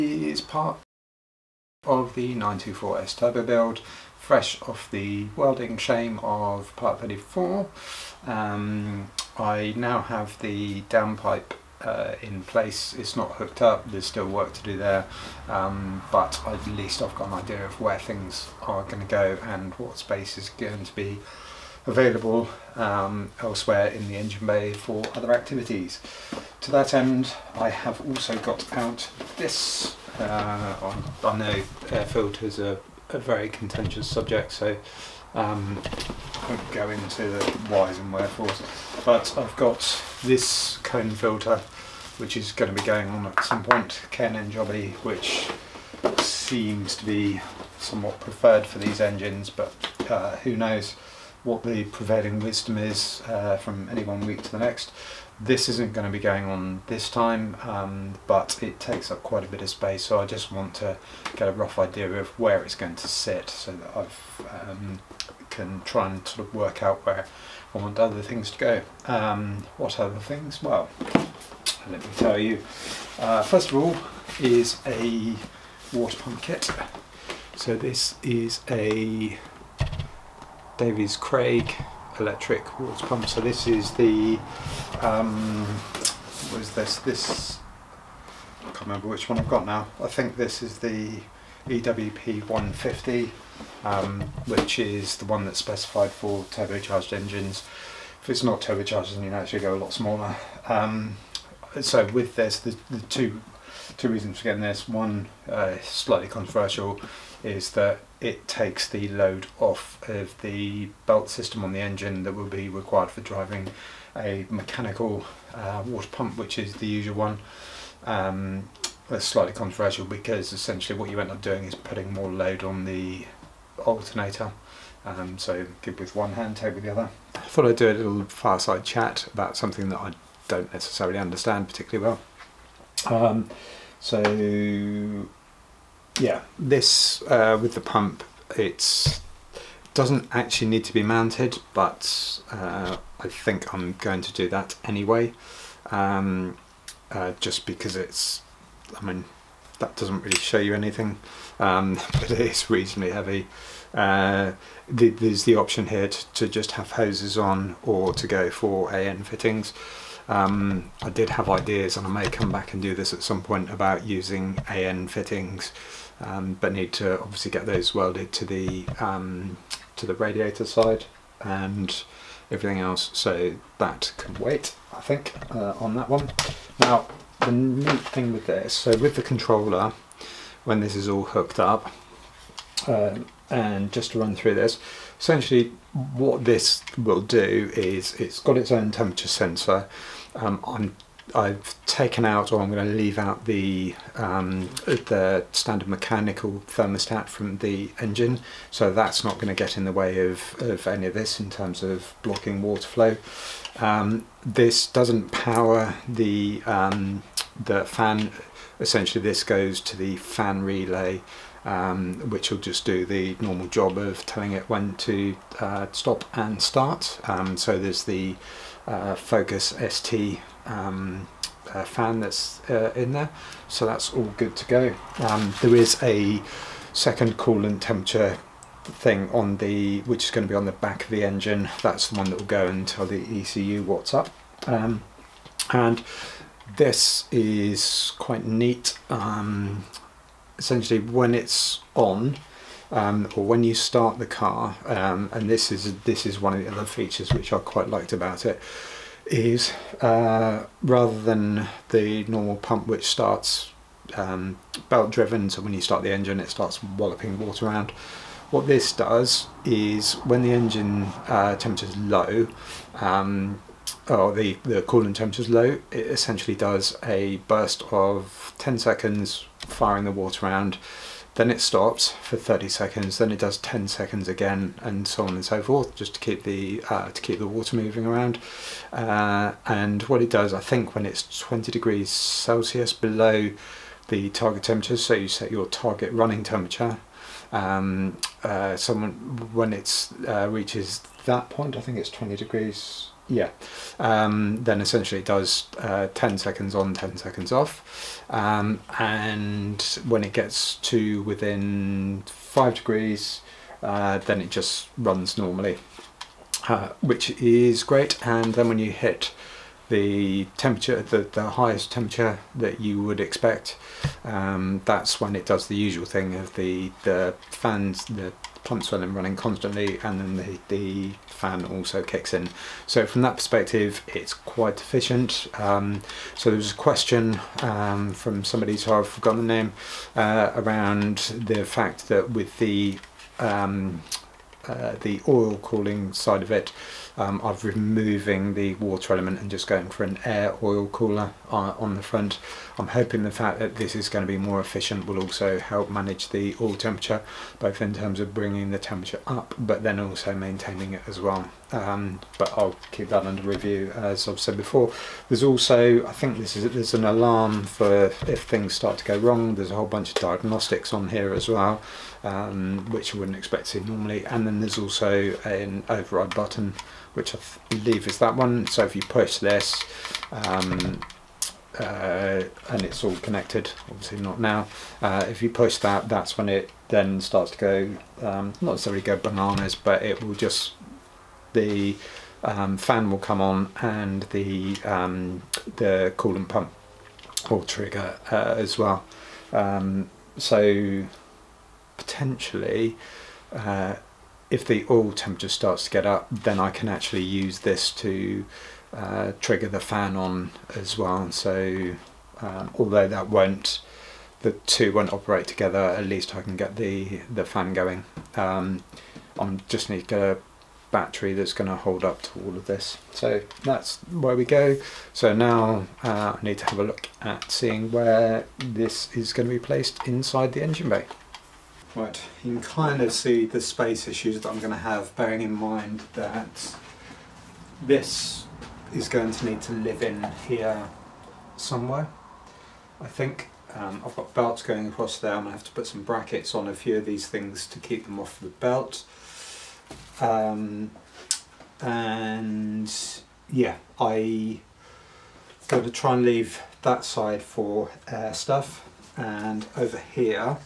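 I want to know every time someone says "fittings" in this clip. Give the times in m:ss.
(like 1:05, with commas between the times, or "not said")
2:39, 2:45.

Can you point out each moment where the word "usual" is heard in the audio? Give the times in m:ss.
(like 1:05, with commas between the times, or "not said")
1:56, 5:15.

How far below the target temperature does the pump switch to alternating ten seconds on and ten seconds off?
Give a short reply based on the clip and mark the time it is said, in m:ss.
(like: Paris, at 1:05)
20 degrees Celsius, at 4:41.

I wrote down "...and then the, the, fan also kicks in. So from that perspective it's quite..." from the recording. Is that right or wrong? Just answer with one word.
right.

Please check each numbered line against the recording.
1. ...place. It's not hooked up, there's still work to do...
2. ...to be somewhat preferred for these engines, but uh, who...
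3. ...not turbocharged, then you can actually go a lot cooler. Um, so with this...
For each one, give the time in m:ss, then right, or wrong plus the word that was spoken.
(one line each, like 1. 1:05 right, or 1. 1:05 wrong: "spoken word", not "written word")
1. 0:12 right
2. 0:46 right
3. 1:38 wrong: "smaller", not "cooler".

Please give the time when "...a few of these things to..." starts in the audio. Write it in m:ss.
7:16.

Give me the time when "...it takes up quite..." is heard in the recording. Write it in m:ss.
0:58.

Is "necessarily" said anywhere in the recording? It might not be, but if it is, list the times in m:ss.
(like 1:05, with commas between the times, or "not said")
2:10, 6:18.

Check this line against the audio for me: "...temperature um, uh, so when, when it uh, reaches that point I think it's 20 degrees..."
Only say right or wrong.
right.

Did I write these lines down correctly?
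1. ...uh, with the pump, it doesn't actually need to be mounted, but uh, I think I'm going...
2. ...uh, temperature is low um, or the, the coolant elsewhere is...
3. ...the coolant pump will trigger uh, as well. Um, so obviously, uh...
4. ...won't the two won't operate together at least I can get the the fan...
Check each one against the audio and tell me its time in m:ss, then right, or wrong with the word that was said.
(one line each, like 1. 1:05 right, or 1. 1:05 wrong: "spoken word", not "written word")
1. 2:17 right
2. 4:21 wrong: "temperature", not "elsewhere"
3. 6:25 wrong: "potentially", not "obviously"
4. 6:43 right.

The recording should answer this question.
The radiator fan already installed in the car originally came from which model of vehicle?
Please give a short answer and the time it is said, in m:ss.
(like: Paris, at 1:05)
Focus ST, at 3:39.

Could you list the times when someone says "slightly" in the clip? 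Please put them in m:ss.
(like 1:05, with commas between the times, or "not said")
1:45, 1:59.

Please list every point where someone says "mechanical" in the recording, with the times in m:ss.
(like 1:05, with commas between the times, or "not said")
1:54, 3:15.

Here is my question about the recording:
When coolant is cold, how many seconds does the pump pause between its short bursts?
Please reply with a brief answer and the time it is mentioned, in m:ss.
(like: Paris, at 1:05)
30 seconds, at 4:32.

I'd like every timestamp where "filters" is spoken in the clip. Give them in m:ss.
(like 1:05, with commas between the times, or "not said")
0:32, 0:41.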